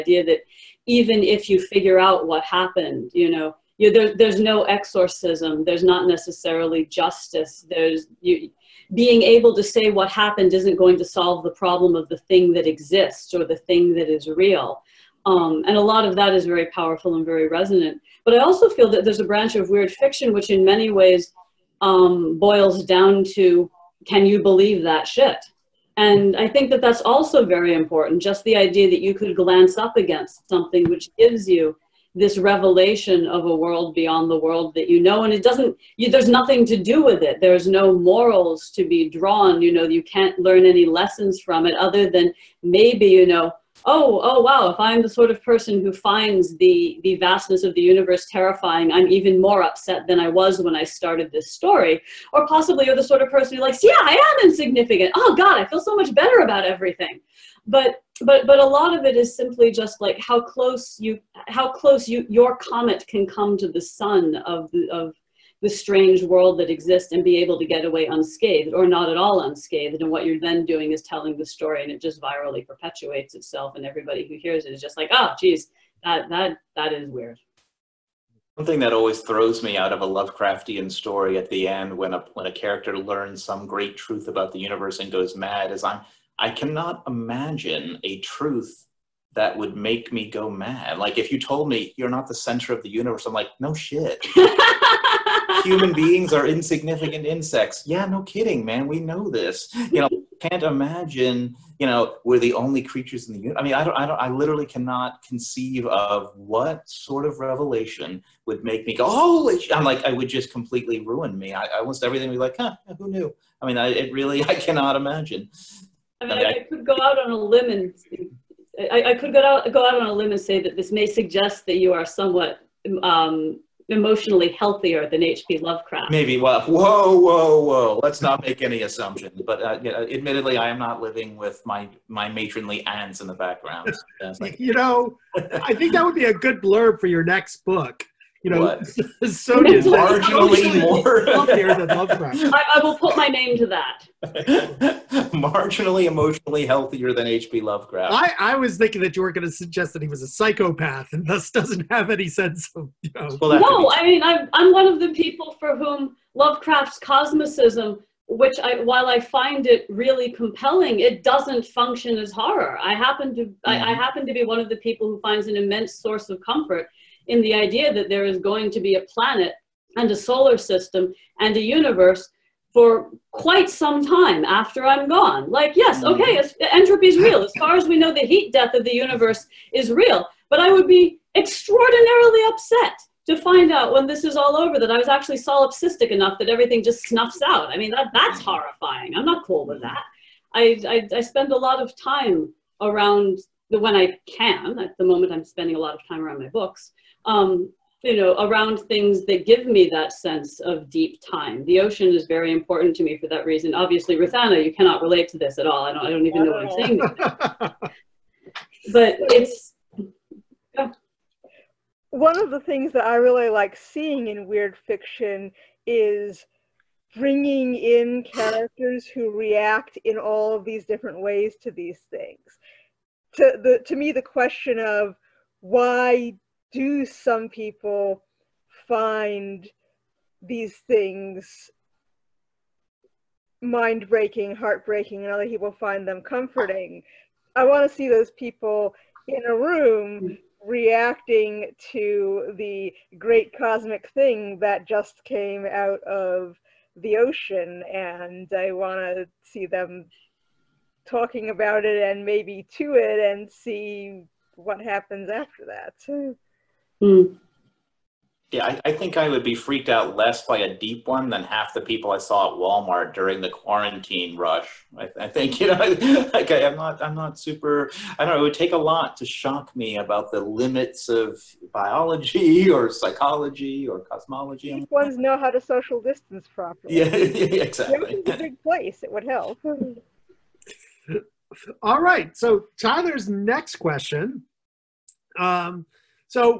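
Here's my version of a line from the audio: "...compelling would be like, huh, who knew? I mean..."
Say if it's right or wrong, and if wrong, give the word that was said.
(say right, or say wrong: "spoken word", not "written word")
wrong: "everything", not "compelling".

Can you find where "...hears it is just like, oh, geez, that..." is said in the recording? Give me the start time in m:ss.
1:14.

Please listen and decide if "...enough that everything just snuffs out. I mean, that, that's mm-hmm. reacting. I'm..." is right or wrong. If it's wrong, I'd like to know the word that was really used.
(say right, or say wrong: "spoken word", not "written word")
wrong: "horrifying", not "reacting".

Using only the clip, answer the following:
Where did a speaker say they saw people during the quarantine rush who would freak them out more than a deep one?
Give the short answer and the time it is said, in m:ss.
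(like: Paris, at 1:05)
Walmart, at 4:22.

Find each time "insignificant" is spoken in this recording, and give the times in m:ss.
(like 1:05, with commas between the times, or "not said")
0:54, 1:36.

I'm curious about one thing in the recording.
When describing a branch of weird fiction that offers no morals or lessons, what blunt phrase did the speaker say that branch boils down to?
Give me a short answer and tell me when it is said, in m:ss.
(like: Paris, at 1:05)
can you believe that shit, at 0:24.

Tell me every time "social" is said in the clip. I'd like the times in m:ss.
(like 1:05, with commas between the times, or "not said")
4:35.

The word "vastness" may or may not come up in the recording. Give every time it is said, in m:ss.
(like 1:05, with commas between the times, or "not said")
0:47.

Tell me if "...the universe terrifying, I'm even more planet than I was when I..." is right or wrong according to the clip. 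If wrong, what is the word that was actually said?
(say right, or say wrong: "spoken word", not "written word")
wrong: "upset", not "planet".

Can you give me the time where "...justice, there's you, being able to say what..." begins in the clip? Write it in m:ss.
0:06.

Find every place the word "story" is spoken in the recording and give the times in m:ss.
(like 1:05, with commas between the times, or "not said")
0:51, 1:11, 1:20.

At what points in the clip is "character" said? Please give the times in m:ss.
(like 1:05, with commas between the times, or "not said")
1:22, 3:38.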